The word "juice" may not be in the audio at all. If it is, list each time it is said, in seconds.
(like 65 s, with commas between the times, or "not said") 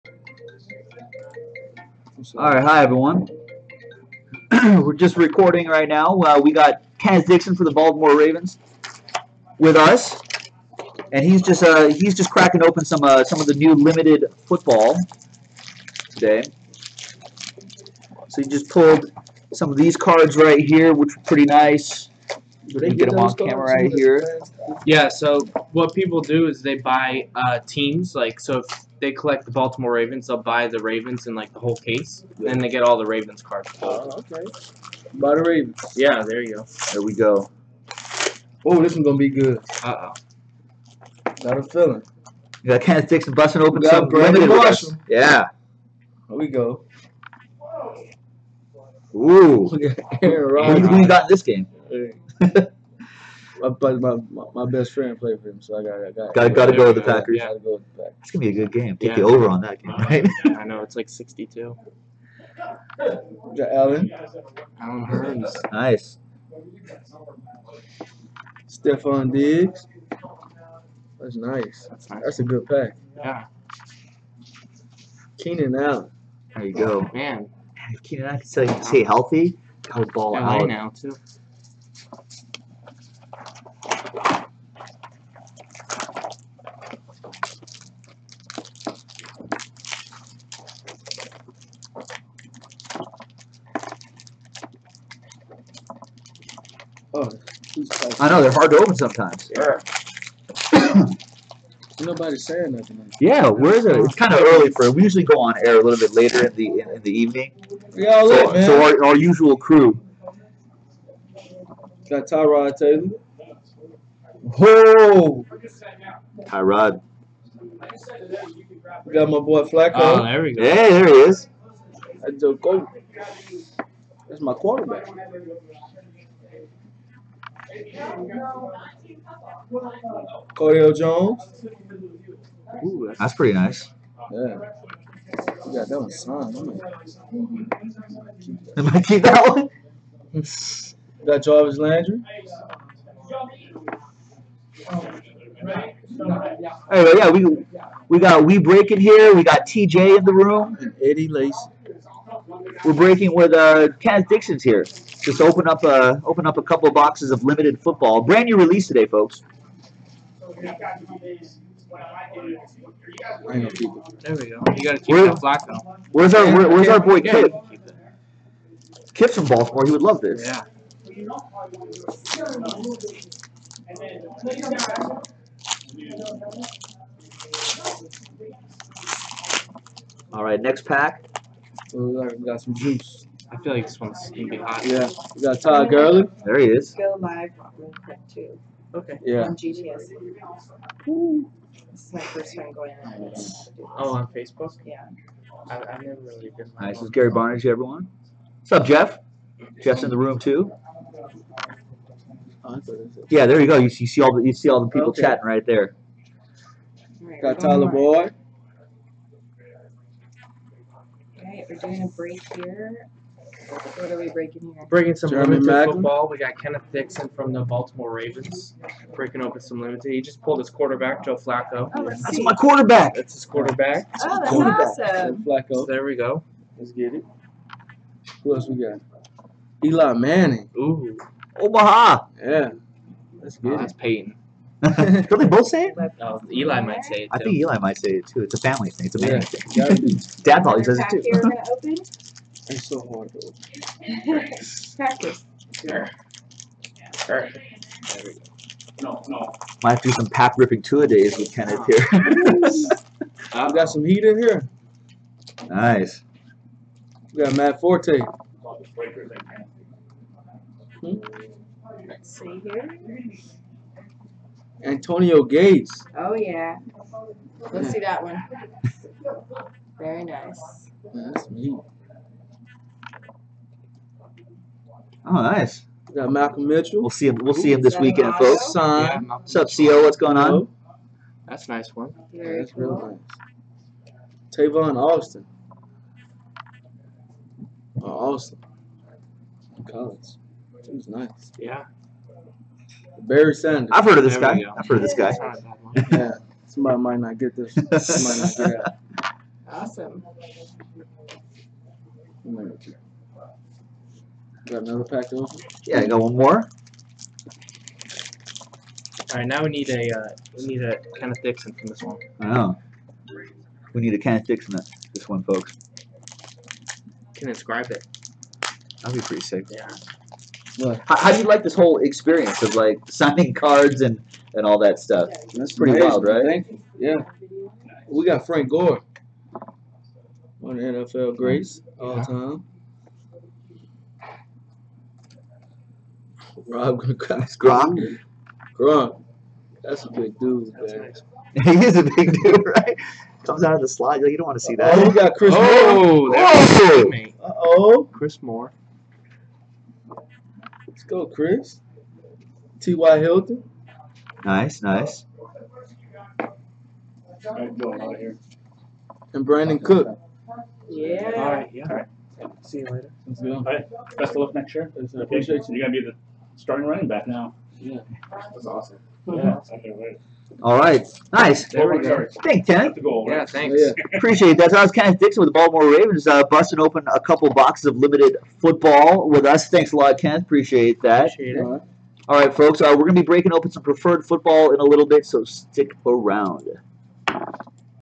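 182 s.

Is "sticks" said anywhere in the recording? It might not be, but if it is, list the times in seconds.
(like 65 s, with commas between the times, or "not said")
43 s, 314 s, 385 s.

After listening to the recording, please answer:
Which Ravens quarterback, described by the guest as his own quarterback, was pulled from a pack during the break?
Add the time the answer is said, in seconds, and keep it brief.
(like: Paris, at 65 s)
Joe Flacco, at 221 s.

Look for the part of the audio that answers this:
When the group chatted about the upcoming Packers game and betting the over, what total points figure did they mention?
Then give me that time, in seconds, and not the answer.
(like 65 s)
61 s.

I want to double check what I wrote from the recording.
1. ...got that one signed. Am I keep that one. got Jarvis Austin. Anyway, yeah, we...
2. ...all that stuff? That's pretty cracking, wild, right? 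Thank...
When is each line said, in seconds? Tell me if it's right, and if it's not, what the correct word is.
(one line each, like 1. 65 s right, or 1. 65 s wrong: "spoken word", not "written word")
1. 135 s wrong: "Landry", not "Austin"
2. 324 s wrong: "amazing", not "cracking".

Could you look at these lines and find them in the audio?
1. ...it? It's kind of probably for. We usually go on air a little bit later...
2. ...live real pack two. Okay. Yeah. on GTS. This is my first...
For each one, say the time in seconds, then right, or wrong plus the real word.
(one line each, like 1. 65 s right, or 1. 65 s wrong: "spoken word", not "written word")
1. 103 s wrong: "early", not "probably"
2. 187 s right.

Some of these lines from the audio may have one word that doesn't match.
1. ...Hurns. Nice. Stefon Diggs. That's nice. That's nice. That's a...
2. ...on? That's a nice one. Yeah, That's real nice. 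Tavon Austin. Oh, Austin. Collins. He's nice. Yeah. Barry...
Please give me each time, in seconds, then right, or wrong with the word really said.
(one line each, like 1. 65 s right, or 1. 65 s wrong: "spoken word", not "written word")
1. 65 s right
2. 280 s right.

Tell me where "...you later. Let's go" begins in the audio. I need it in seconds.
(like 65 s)
362 s.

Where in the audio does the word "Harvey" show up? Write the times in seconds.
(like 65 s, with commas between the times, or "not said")
not said.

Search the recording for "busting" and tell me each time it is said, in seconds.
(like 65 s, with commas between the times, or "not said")
43 s, 376 s.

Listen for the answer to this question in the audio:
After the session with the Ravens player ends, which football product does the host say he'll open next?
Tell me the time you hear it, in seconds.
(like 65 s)
383 s.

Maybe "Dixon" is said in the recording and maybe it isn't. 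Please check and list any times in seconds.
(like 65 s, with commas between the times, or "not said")
7 s, 154 s, 216 s, 311 s, 375 s.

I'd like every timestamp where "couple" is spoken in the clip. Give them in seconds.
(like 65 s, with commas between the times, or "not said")
156 s, 377 s.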